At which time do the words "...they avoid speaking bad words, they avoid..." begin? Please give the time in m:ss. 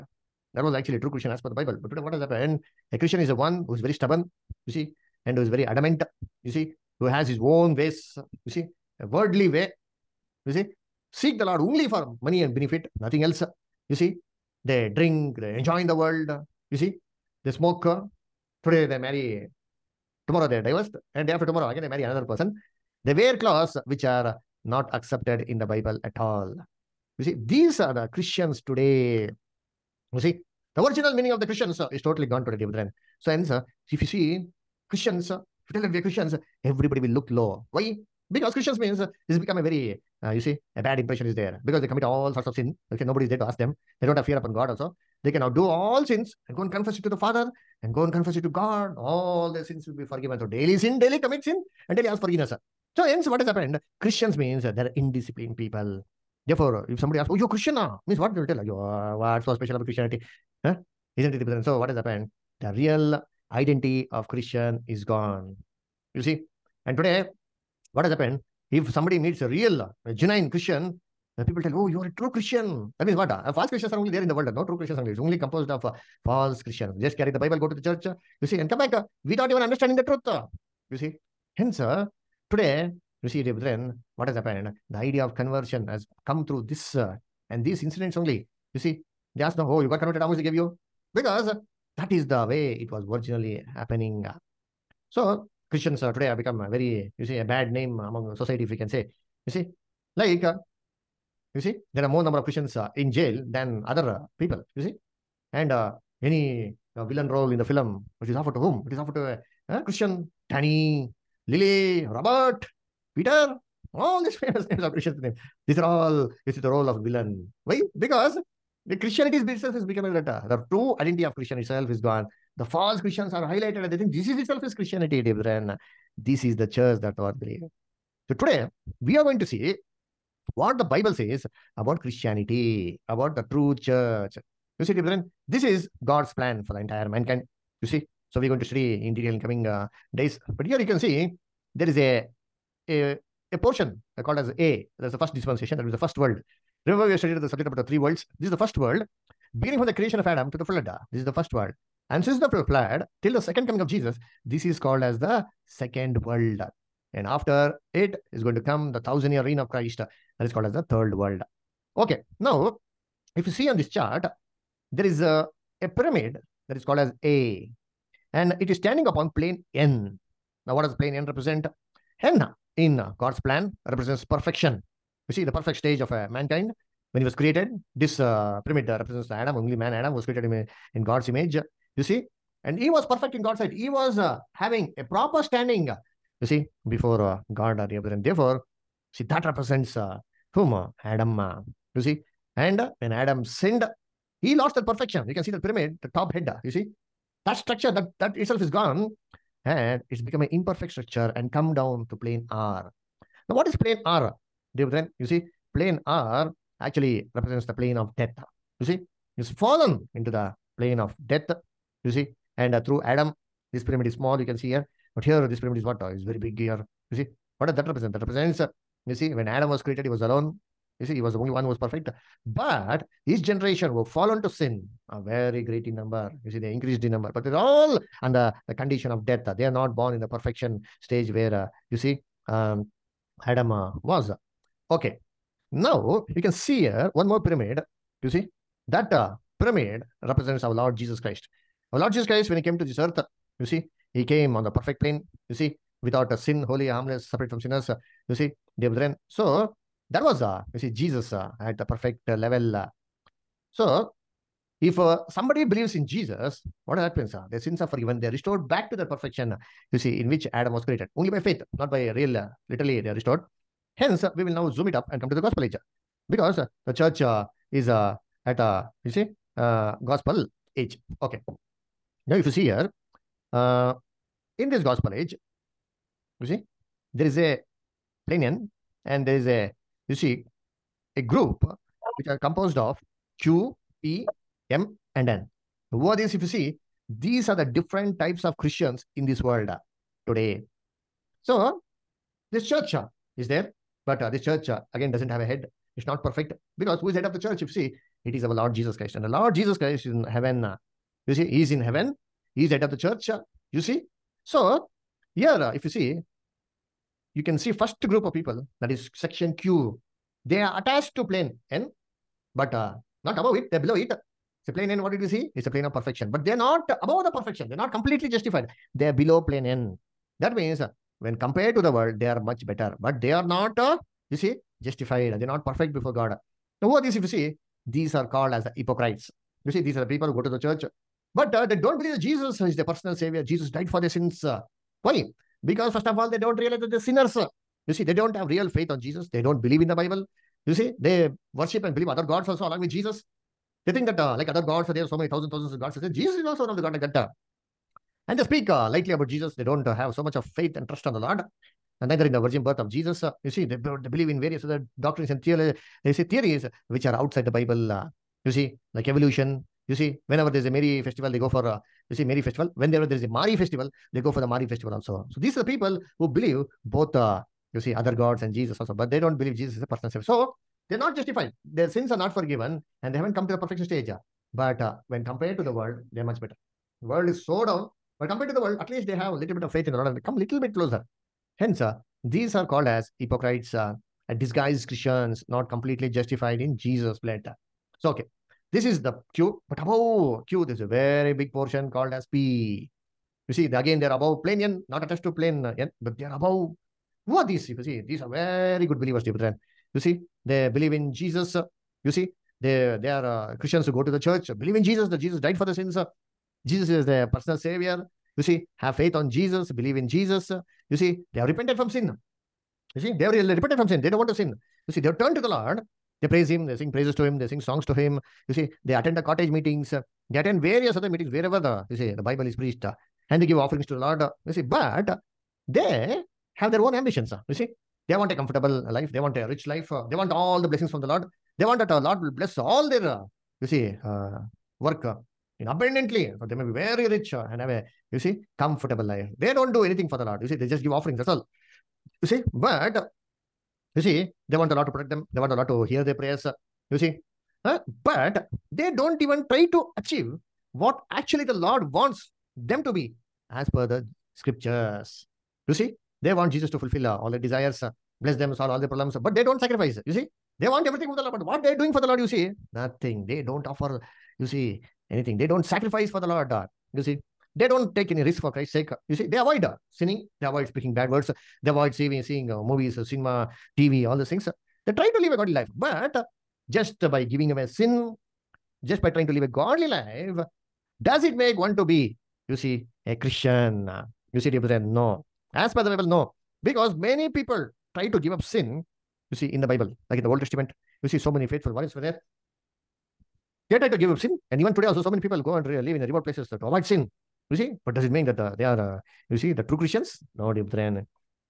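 7:50.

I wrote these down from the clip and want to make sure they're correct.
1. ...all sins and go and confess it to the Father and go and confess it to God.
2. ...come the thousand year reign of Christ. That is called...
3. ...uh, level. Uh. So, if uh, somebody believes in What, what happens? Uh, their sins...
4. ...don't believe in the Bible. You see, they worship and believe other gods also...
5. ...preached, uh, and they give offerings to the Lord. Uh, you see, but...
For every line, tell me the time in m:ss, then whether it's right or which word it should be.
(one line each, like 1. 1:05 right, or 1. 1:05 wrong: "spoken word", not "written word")
1. 0:45 right
2. 2:38 right
3. 4:12 wrong: "Jesus", not "What"
4. 5:39 right
5. 7:02 right.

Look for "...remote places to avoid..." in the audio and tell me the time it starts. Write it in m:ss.
8:16.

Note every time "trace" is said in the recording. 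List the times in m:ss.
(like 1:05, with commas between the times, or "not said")
not said.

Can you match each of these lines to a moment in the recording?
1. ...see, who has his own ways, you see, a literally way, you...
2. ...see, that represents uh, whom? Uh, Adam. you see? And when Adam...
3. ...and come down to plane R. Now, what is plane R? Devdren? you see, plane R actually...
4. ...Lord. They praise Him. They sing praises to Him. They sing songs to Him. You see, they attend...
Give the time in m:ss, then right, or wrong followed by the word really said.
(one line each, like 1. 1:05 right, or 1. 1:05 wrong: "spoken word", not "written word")
1. 0:06 wrong: "worldly", not "literally"
2. 3:09 right
3. 3:21 right
4. 6:55 right.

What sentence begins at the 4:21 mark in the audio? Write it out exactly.
Only by faith, not by real, uh, literally, they are restored.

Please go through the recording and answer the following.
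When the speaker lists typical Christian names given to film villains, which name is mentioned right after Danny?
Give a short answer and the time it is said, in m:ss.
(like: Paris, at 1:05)
Lily, at 1:51.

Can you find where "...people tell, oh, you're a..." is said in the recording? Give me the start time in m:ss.
1:11.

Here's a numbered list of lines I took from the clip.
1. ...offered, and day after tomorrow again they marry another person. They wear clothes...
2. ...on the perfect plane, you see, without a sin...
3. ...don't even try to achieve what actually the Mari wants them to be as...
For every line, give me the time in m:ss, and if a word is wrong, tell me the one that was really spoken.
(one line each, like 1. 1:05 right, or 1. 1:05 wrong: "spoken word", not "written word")
1. 0:20 wrong: "divorced", not "offered"
2. 4:04 right
3. 7:28 wrong: "Lord", not "Mari".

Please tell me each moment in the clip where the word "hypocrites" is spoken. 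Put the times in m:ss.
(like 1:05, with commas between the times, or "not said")
5:28, 6:23.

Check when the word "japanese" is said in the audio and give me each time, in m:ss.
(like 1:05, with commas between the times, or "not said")
not said.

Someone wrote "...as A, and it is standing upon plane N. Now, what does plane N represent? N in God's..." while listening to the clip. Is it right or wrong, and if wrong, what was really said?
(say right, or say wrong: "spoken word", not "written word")
right.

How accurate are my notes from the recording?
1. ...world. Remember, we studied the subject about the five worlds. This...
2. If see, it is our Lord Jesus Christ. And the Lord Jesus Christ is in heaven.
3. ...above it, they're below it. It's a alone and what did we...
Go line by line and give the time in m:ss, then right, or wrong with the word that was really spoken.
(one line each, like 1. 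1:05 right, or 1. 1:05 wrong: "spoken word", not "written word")
1. 2:26 wrong: "three", not "five"
2. 4:57 right
3. 5:13 wrong: "plane", not "alone".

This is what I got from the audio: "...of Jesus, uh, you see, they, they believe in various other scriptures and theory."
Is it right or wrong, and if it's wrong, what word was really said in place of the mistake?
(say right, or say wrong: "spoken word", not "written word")
wrong: "doctrines", not "scriptures".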